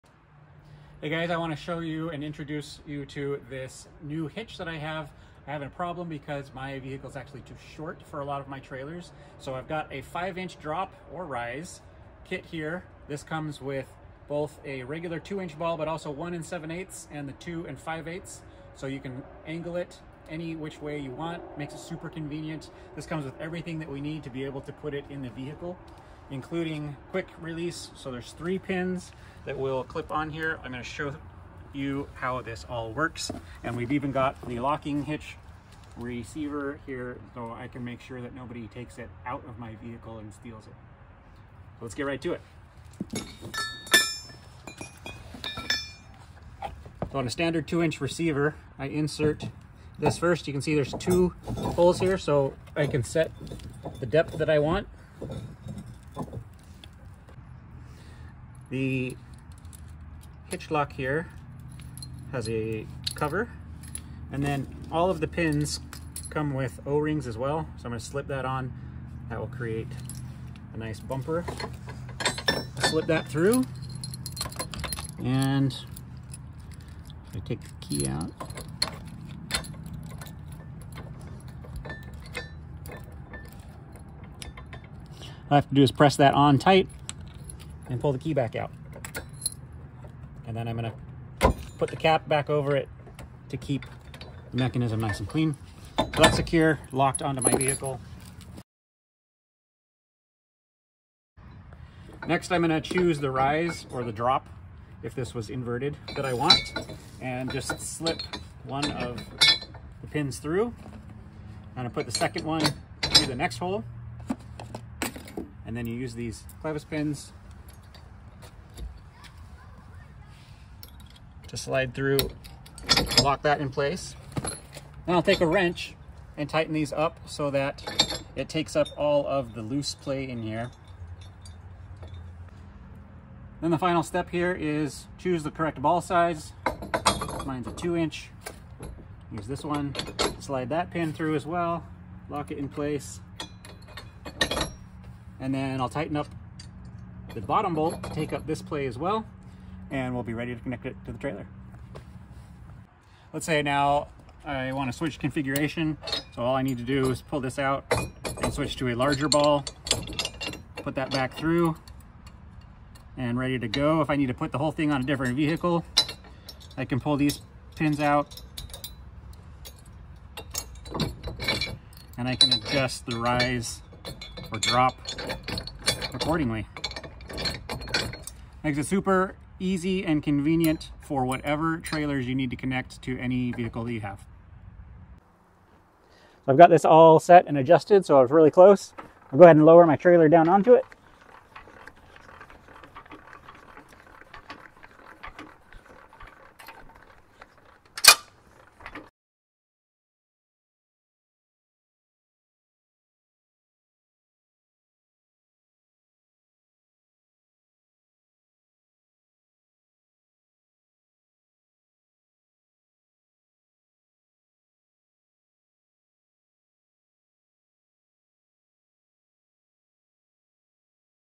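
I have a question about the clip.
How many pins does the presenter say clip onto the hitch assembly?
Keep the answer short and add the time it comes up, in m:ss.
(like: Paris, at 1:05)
3, at 0:28.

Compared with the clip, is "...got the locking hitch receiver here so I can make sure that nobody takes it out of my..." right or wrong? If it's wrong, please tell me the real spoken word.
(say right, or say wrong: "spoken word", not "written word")
right.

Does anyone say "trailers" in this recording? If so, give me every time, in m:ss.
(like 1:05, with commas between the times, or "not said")
0:08, 2:31, 3:01, 3:09.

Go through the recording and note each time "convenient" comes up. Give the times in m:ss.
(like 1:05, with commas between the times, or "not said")
0:22, 3:00.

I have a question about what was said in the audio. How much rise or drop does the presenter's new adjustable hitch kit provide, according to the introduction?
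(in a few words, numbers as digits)
5 inches.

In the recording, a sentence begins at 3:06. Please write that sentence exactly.
I've got this all set and adjusted, so I was really close.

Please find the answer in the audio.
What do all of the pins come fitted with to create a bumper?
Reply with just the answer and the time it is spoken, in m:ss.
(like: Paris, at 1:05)
O-rings, at 1:06.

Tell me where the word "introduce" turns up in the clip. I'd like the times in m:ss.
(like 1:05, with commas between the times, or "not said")
0:02.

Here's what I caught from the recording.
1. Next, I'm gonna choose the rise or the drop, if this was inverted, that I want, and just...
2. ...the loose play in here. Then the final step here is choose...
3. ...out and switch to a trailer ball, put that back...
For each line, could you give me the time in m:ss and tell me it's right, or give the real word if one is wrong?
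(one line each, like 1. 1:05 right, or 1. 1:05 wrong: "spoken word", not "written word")
1. 1:42 right
2. 2:09 right
3. 2:37 wrong: "larger", not "trailer".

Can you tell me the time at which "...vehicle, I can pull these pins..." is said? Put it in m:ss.
2:45.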